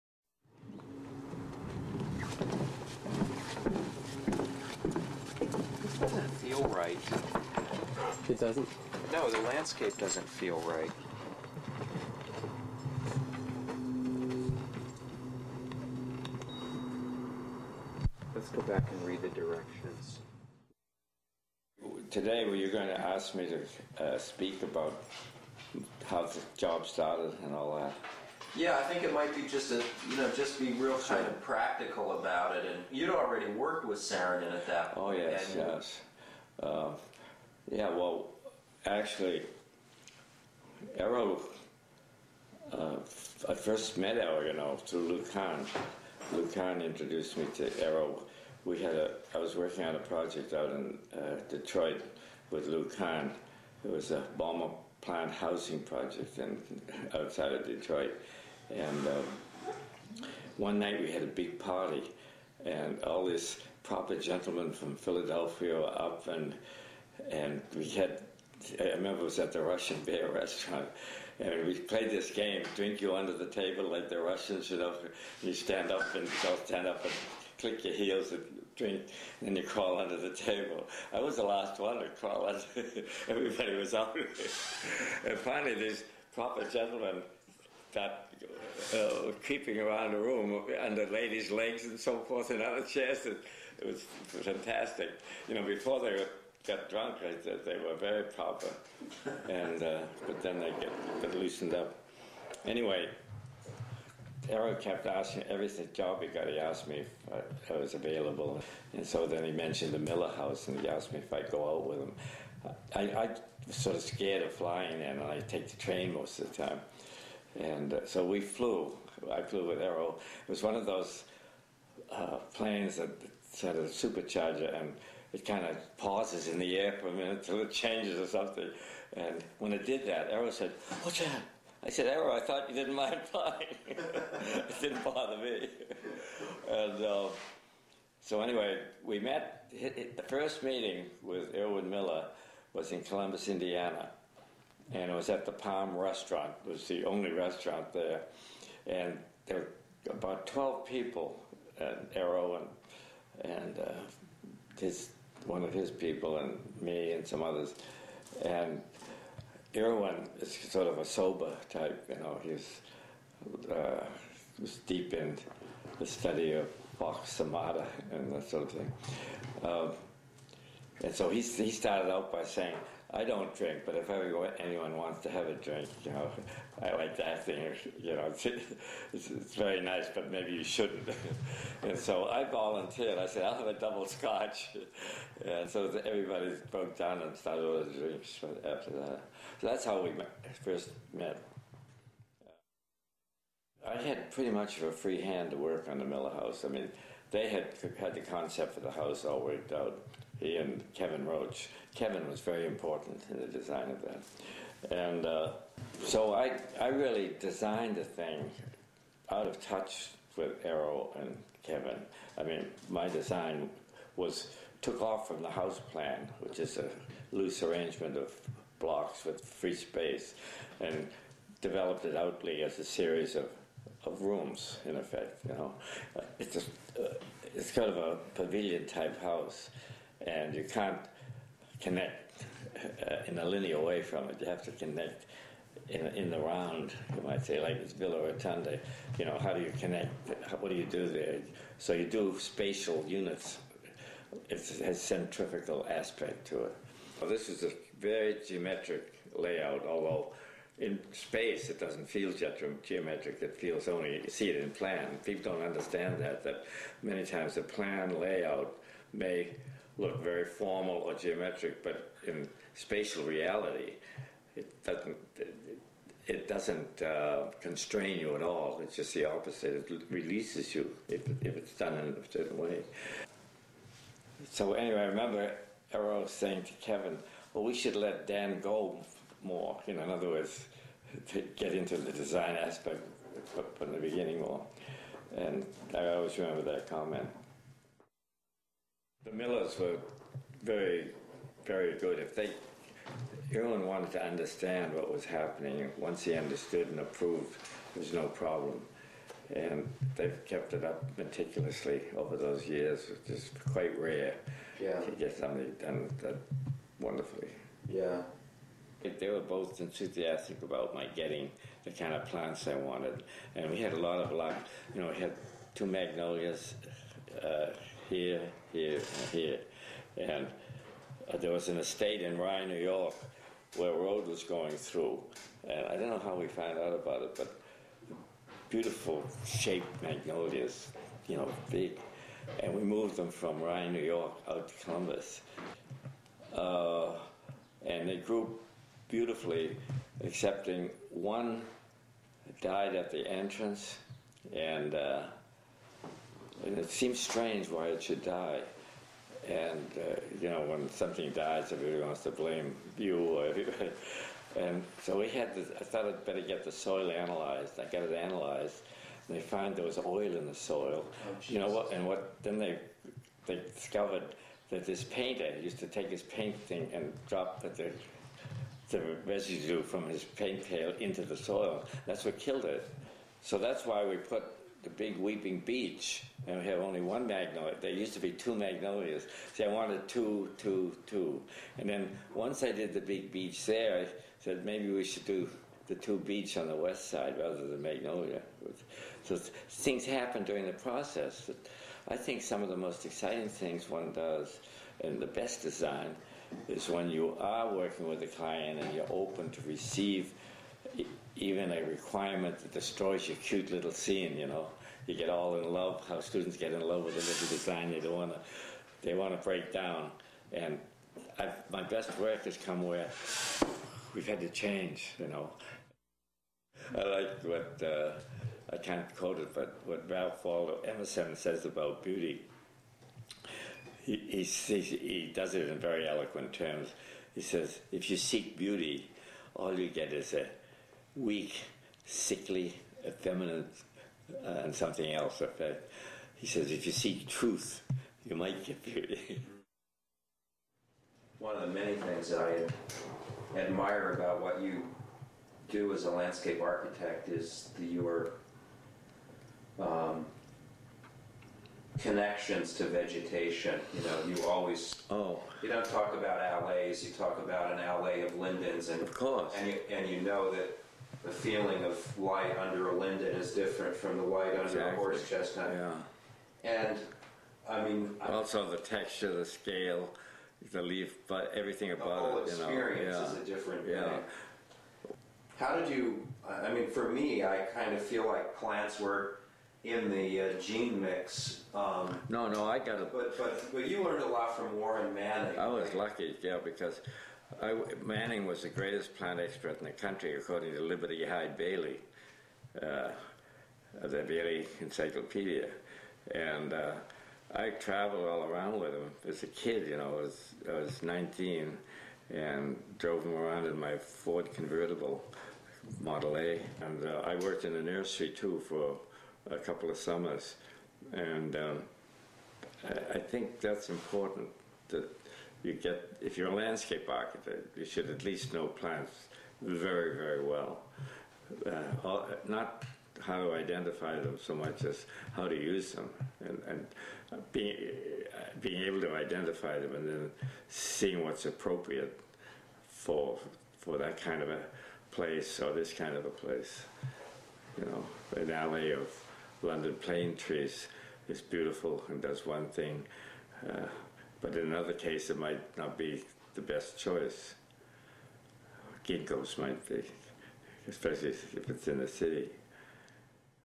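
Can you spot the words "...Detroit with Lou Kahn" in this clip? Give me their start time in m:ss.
0:51.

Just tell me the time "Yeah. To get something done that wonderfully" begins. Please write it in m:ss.
5:04.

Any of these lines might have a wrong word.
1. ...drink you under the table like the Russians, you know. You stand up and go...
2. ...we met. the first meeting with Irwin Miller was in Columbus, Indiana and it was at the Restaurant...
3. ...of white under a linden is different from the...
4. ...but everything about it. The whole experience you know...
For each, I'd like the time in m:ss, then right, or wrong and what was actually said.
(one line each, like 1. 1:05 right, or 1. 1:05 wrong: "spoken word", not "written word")
1. 1:12 right
2. 2:19 wrong: "Palm", not "Restaurant"
3. 7:41 right
4. 7:51 right.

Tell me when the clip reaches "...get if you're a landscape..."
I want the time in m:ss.
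8:35.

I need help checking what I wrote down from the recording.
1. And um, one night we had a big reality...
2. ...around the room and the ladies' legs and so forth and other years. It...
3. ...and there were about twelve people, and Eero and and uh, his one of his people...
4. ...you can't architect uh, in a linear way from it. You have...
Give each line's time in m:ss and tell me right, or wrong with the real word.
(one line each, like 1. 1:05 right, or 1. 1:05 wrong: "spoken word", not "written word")
1. 0:58 wrong: "party", not "reality"
2. 1:29 wrong: "chairs", not "years"
3. 2:28 right
4. 3:50 wrong: "connect", not "architect".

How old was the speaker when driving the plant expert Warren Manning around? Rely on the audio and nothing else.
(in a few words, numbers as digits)
19.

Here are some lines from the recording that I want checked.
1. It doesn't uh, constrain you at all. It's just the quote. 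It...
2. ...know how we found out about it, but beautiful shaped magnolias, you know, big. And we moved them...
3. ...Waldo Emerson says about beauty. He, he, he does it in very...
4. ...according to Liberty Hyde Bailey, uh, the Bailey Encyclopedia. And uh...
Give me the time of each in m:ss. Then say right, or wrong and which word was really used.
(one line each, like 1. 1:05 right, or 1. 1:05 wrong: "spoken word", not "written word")
1. 4:26 wrong: "opposite", not "quote"
2. 5:26 right
3. 7:00 right
4. 8:10 right.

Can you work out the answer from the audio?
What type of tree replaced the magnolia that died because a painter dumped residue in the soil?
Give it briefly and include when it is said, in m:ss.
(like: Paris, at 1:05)
Weeping beech, at 6:15.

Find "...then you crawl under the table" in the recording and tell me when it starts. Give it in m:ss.
1:19.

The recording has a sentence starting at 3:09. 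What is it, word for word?
So that's how we met, first met.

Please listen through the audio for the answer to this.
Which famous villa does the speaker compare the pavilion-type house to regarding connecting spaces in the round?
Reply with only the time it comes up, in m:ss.
3:57.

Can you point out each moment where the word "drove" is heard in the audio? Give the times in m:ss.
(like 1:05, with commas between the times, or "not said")
8:22.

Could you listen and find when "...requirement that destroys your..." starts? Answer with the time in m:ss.
6:41.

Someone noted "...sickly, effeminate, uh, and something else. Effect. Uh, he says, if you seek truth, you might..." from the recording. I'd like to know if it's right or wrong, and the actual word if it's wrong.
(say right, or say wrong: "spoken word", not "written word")
right.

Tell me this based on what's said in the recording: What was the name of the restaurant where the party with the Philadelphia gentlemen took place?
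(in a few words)
Russian Bear.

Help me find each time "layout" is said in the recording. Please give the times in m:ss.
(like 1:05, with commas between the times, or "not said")
4:09, 4:18.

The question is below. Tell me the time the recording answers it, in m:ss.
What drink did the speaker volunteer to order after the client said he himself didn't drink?
3:03.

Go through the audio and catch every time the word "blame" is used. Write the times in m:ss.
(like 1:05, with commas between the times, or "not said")
5:52.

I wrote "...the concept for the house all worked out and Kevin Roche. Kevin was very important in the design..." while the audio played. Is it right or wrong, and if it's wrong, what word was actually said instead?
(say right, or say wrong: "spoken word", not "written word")
right.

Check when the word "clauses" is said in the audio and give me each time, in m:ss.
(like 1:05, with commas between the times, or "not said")
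not said.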